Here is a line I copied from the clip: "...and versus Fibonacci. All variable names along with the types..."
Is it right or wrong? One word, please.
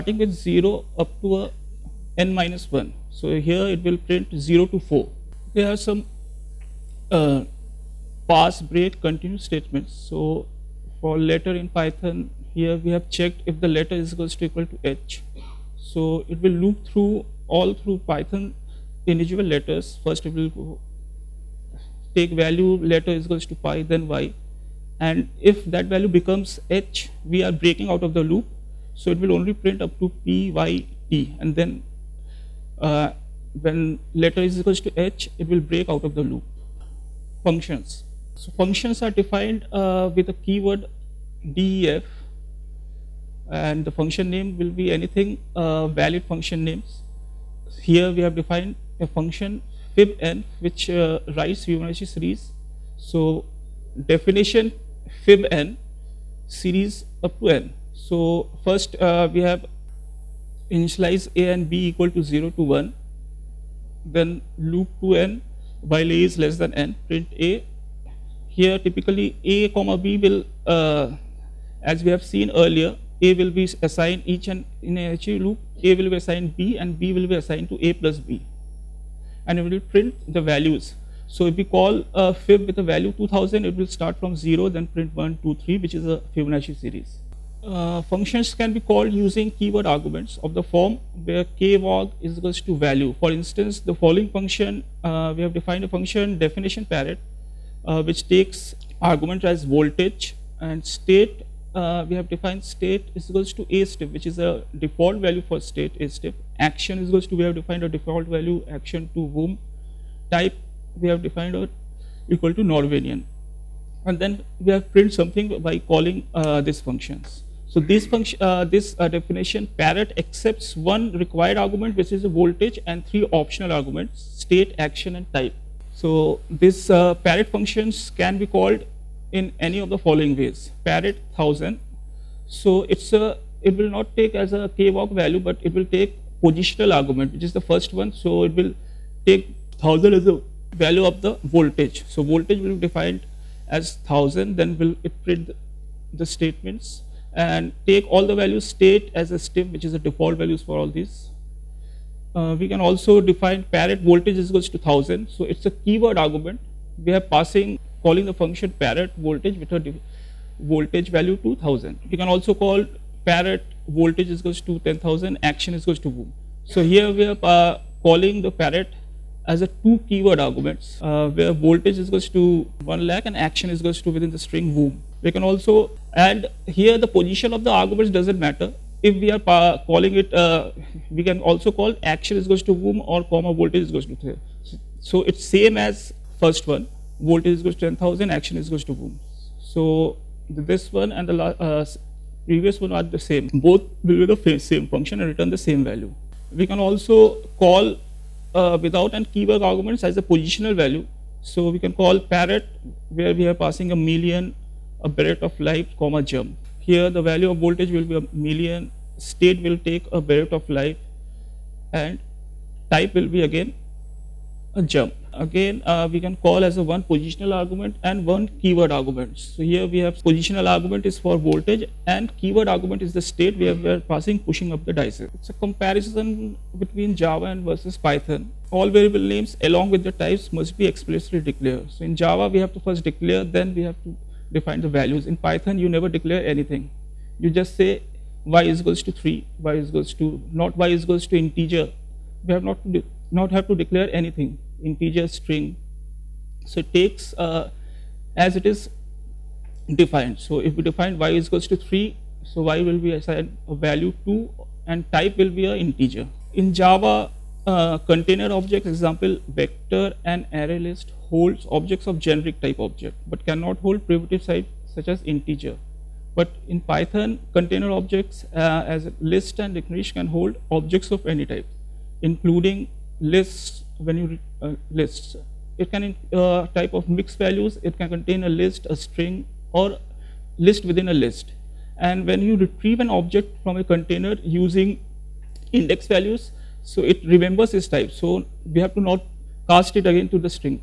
wrong.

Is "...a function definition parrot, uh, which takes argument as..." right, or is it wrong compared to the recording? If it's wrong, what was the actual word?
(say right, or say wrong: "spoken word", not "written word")
right.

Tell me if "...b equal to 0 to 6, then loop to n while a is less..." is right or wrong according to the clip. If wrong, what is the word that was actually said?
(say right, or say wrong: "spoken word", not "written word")
wrong: "1", not "6".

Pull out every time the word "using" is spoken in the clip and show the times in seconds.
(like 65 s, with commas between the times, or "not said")
89 s, 284 s.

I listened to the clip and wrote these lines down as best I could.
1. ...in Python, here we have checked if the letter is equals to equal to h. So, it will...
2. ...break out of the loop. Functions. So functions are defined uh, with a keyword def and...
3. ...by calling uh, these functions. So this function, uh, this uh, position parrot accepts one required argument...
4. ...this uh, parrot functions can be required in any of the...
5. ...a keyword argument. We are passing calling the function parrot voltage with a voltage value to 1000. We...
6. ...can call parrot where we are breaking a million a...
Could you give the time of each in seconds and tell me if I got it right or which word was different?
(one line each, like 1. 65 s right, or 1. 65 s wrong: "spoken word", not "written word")
1. 11 s right
2. 35 s right
3. 115 s wrong: "definition", not "position"
4. 126 s wrong: "called", not "required"
5. 155 s right
6. 201 s wrong: "passing", not "breaking".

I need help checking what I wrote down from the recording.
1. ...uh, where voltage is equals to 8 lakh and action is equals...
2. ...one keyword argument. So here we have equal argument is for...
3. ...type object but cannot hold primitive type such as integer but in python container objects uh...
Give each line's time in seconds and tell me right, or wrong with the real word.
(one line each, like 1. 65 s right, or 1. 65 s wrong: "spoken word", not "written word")
1. 171 s wrong: "1", not "8"
2. 218 s wrong: "positional", not "equal"
3. 262 s right.